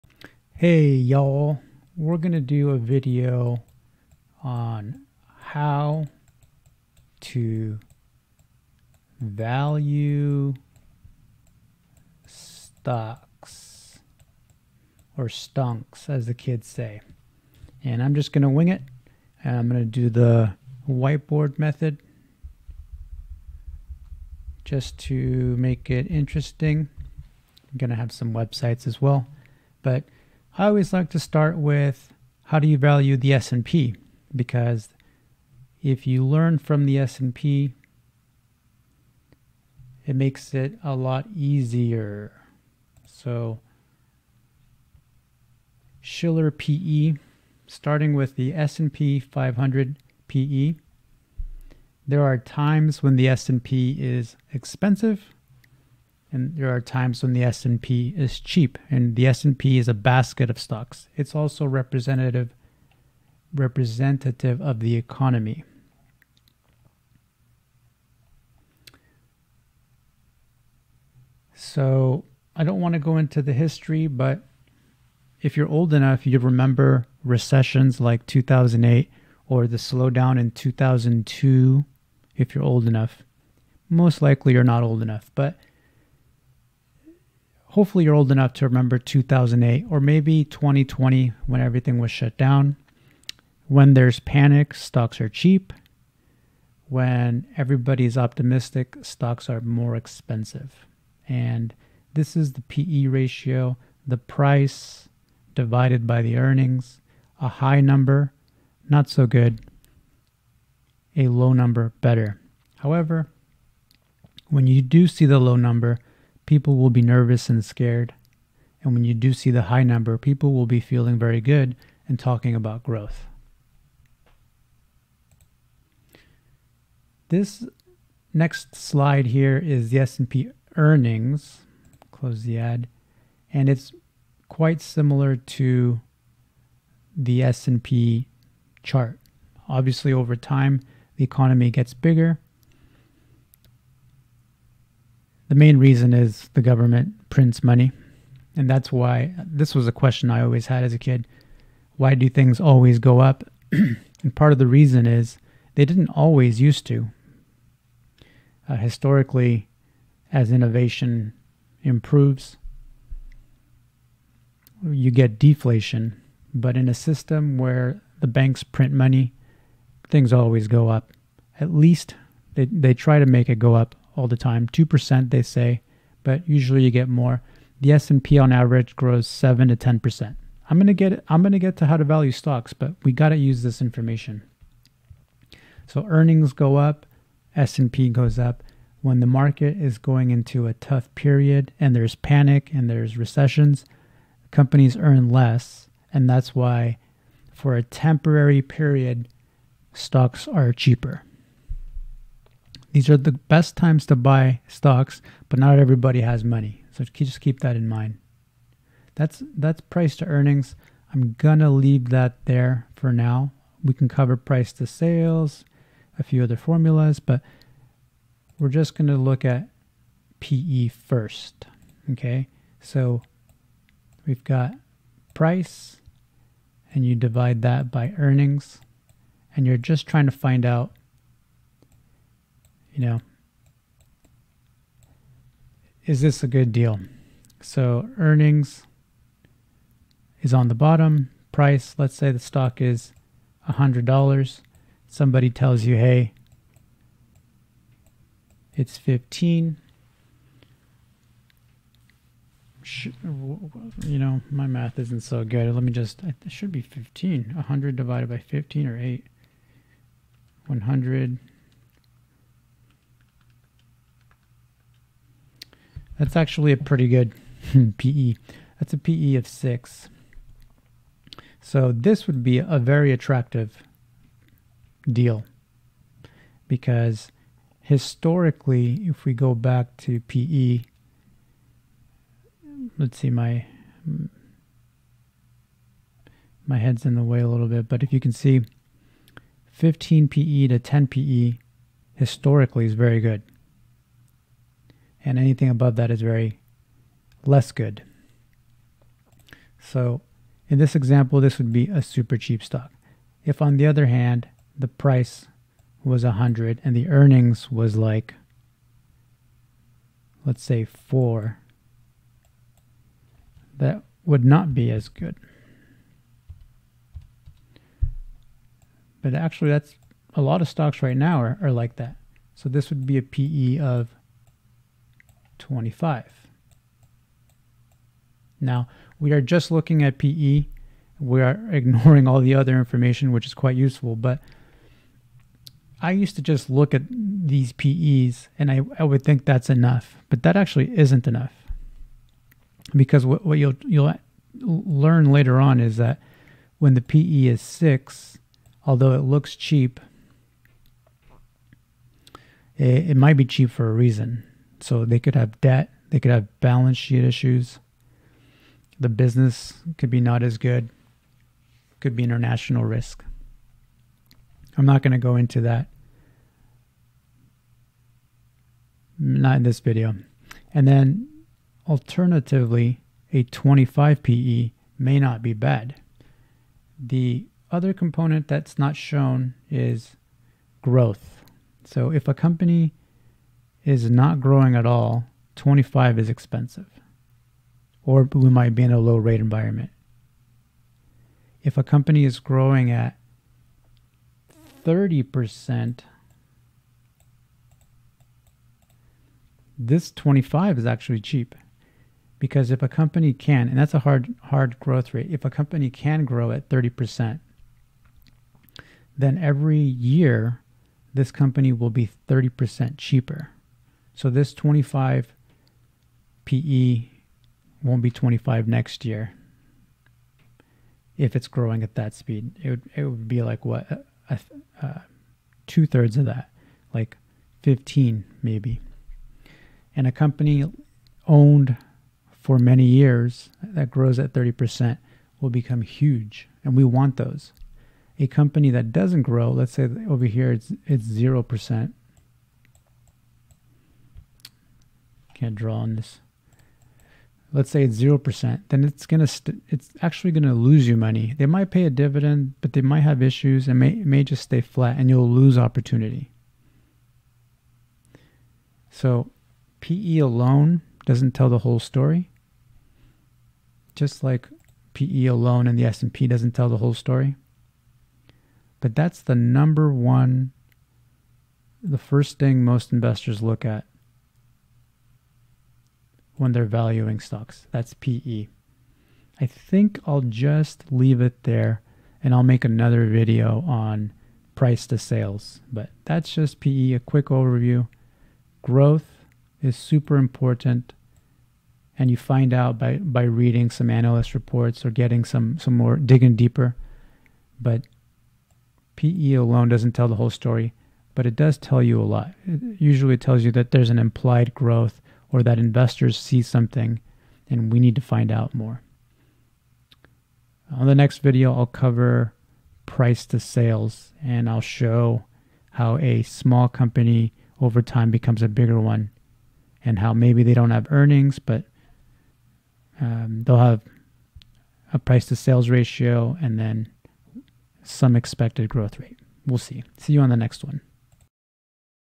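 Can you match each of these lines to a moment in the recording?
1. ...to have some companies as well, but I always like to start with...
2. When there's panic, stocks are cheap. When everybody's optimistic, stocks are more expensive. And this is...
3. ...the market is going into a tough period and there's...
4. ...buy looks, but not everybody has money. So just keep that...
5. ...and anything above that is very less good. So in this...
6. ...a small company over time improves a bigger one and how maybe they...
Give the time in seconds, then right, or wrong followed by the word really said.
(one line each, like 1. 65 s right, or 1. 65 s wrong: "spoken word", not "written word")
1. 27 s wrong: "websites", not "companies"
2. 93 s right
3. 189 s right
4. 204 s wrong: "stocks", not "looks"
5. 295 s right
6. 515 s wrong: "becomes", not "improves".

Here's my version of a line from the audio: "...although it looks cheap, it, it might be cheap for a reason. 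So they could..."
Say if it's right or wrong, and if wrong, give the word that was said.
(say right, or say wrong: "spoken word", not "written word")
right.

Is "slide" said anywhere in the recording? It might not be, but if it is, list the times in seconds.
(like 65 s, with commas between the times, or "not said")
128 s.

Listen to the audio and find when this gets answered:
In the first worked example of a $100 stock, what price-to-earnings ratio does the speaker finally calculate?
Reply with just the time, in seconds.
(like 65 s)
268 s.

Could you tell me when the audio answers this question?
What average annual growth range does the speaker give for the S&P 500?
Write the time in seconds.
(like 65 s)
179 s.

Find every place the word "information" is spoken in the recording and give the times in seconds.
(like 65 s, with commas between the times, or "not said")
183 s, 332 s.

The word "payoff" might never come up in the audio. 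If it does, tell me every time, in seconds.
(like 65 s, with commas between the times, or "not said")
not said.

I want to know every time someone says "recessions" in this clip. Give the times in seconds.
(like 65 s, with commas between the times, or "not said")
77 s, 193 s.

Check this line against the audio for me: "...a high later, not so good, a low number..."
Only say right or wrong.
wrong.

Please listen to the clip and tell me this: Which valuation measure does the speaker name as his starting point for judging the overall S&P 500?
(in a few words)
Shiller PE.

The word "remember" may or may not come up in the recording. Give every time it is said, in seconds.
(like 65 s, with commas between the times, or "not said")
76 s, 88 s.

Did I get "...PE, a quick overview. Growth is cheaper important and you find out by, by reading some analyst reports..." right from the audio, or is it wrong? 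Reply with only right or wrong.
wrong.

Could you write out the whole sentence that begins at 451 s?
They might pay a dividend, but they might have issues and may, may just stay flat and you'll lose opportunity.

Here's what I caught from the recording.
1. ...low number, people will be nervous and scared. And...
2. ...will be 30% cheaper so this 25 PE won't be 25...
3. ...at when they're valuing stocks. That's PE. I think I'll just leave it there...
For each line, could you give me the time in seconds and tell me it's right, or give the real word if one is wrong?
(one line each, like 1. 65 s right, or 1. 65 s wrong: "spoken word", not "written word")
1. 115 s right
2. 411 s right
3. 473 s right.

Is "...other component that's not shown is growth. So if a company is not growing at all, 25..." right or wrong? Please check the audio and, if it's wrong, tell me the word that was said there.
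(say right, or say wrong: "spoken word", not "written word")
right.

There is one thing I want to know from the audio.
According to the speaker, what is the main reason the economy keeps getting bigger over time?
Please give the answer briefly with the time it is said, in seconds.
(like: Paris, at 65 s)
government prints money, at 146 s.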